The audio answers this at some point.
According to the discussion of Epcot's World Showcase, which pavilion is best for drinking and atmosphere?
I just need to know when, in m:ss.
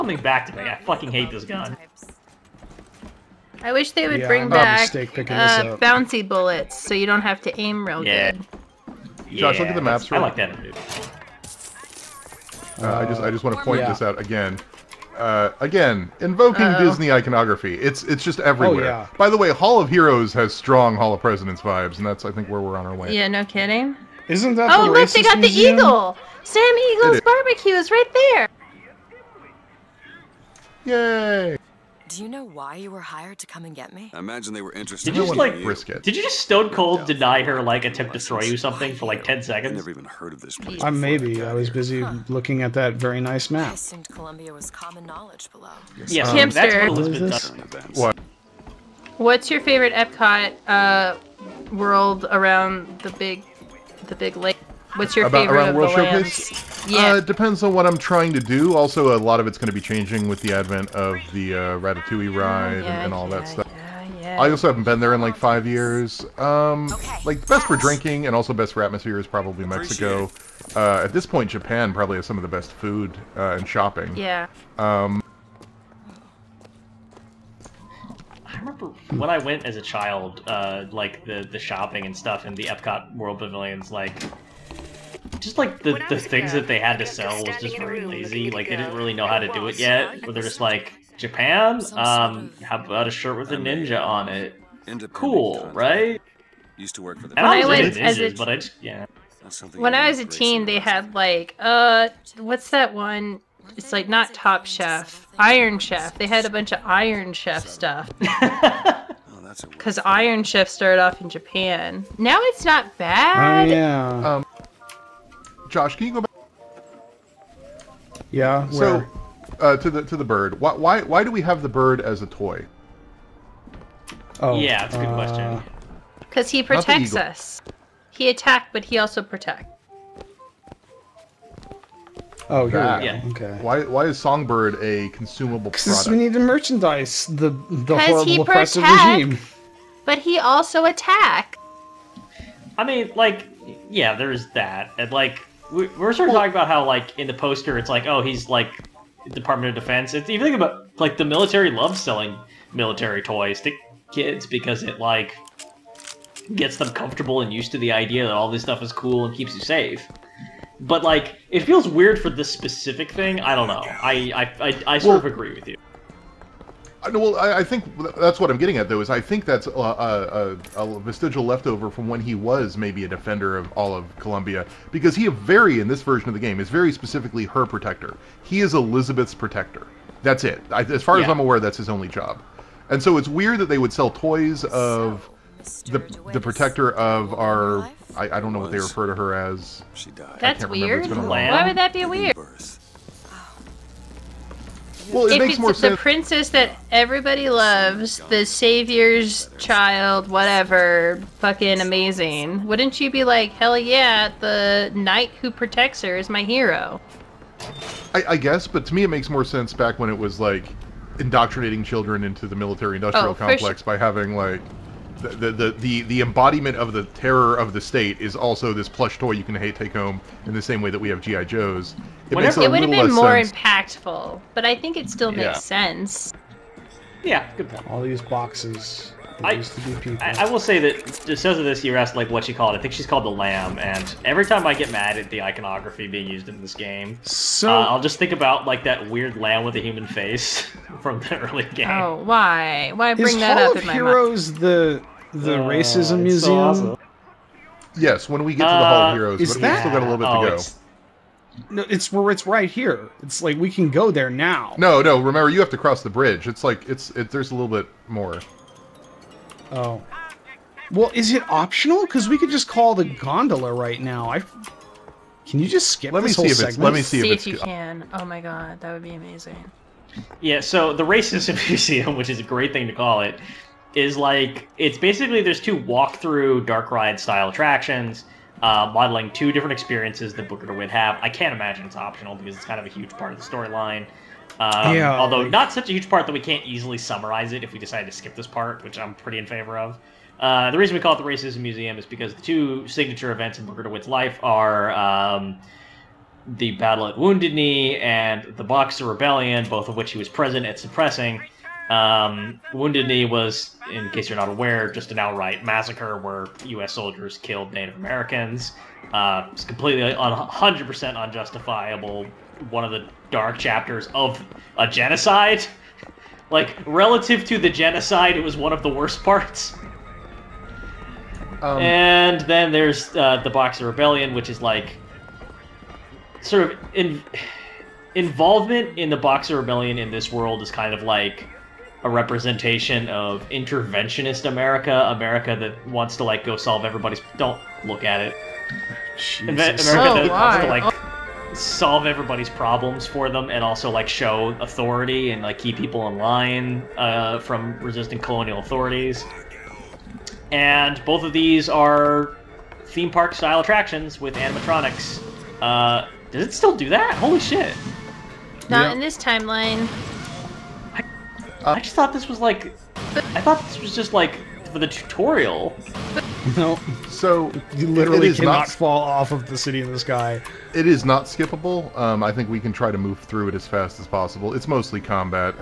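1:09.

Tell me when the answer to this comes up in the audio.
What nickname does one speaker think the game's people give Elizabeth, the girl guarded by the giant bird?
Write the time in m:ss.
3:53.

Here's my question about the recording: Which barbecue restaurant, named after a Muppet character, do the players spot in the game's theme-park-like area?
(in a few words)
Sam Eagle's barbecue.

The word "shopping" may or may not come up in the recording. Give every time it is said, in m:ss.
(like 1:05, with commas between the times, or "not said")
1:13, 1:21.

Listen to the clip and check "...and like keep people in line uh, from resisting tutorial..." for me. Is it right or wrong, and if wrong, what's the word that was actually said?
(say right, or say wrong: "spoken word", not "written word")
wrong: "colonial", not "tutorial".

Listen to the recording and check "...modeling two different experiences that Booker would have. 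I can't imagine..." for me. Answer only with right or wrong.
right.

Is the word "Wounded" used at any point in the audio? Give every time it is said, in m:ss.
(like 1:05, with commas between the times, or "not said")
4:57, 5:02.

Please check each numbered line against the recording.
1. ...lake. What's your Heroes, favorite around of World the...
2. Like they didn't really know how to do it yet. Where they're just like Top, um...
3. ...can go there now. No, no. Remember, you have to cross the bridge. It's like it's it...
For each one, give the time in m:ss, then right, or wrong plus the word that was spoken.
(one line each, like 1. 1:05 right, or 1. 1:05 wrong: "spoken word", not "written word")
1. 0:54 wrong: "About", not "Heroes"
2. 1:28 wrong: "Japan", not "Top"
3. 4:13 right.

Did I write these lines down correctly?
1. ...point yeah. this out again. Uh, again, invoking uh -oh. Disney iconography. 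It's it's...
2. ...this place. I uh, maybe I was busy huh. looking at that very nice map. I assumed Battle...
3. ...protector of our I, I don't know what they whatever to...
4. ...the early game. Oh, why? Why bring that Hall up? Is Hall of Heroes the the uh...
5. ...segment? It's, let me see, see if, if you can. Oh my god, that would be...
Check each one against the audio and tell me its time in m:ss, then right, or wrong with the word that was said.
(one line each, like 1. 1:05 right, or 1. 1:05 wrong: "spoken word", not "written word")
1. 0:13 right
2. 0:40 wrong: "Columbia", not "Battle"
3. 3:06 wrong: "refer", not "whatever"
4. 4:01 right
5. 4:26 right.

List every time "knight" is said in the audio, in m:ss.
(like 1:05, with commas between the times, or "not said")
3:24.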